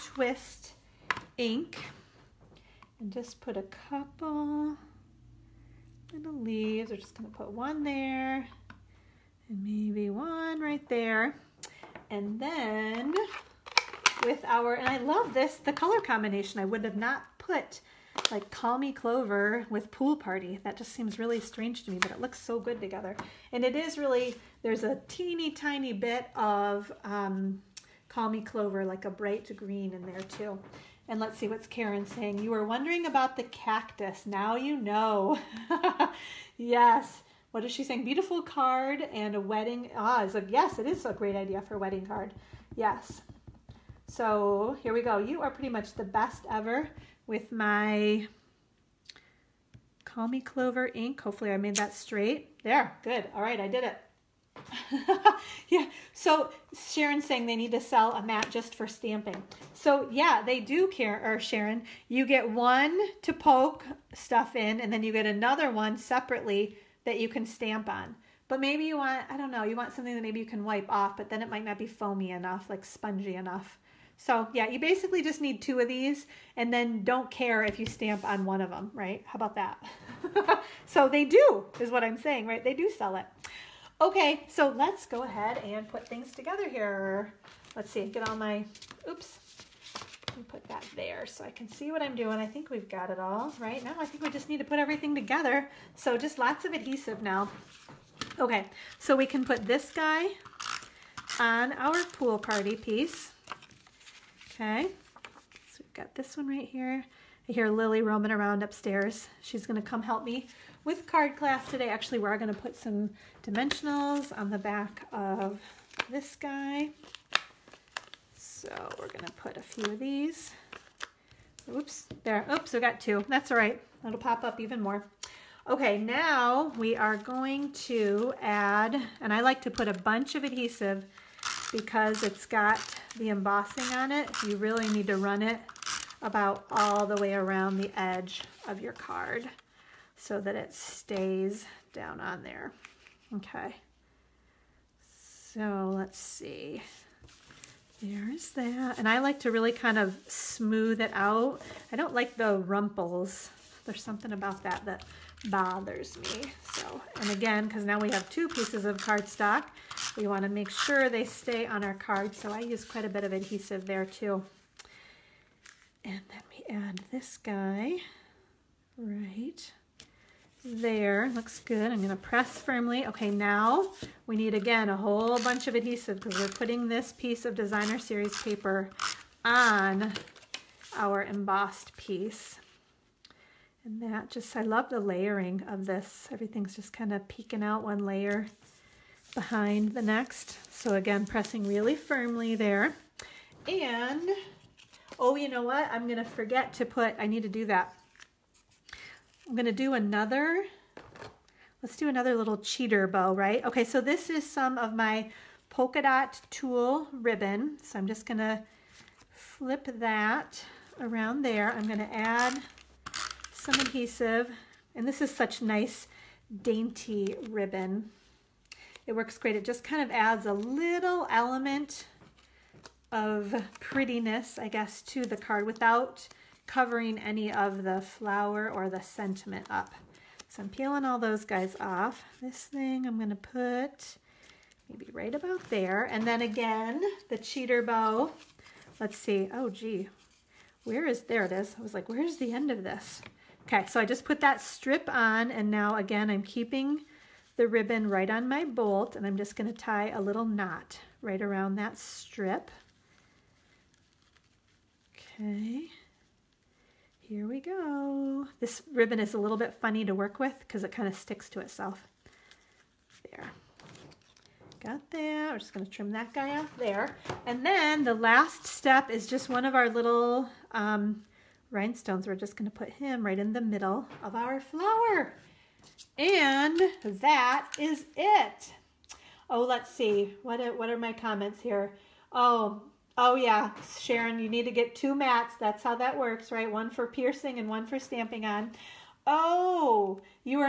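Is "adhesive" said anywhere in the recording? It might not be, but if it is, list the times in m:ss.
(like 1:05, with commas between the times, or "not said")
1:36, 2:10, 2:43, 2:55, 3:33.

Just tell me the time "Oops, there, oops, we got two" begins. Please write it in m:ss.
2:01.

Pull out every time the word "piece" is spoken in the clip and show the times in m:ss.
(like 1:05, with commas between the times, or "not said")
1:42, 2:38, 2:57, 3:01.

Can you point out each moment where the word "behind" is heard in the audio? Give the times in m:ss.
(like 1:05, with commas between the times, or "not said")
3:09.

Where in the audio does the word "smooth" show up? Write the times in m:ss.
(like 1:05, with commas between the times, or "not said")
2:30.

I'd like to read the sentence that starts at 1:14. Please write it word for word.
So yeah, you basically just need two of these and then don't care if you stamp on one of them, right?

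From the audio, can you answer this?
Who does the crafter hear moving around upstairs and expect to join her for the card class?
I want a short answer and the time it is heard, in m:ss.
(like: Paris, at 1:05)
Lily, at 1:47.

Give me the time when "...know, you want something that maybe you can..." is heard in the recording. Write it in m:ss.
1:09.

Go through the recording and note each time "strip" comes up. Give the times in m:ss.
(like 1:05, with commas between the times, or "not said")
4:04, 4:11.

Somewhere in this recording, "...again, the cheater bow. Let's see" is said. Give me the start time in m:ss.
3:56.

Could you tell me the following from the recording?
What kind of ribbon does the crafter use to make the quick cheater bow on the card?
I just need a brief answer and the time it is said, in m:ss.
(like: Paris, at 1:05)
polka dot tulle ribbon, at 3:25.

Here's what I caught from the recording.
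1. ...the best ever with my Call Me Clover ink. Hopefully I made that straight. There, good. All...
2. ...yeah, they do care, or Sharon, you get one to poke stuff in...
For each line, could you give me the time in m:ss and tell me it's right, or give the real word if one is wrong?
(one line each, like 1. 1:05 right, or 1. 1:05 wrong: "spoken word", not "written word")
1. 0:45 right
2. 1:00 right.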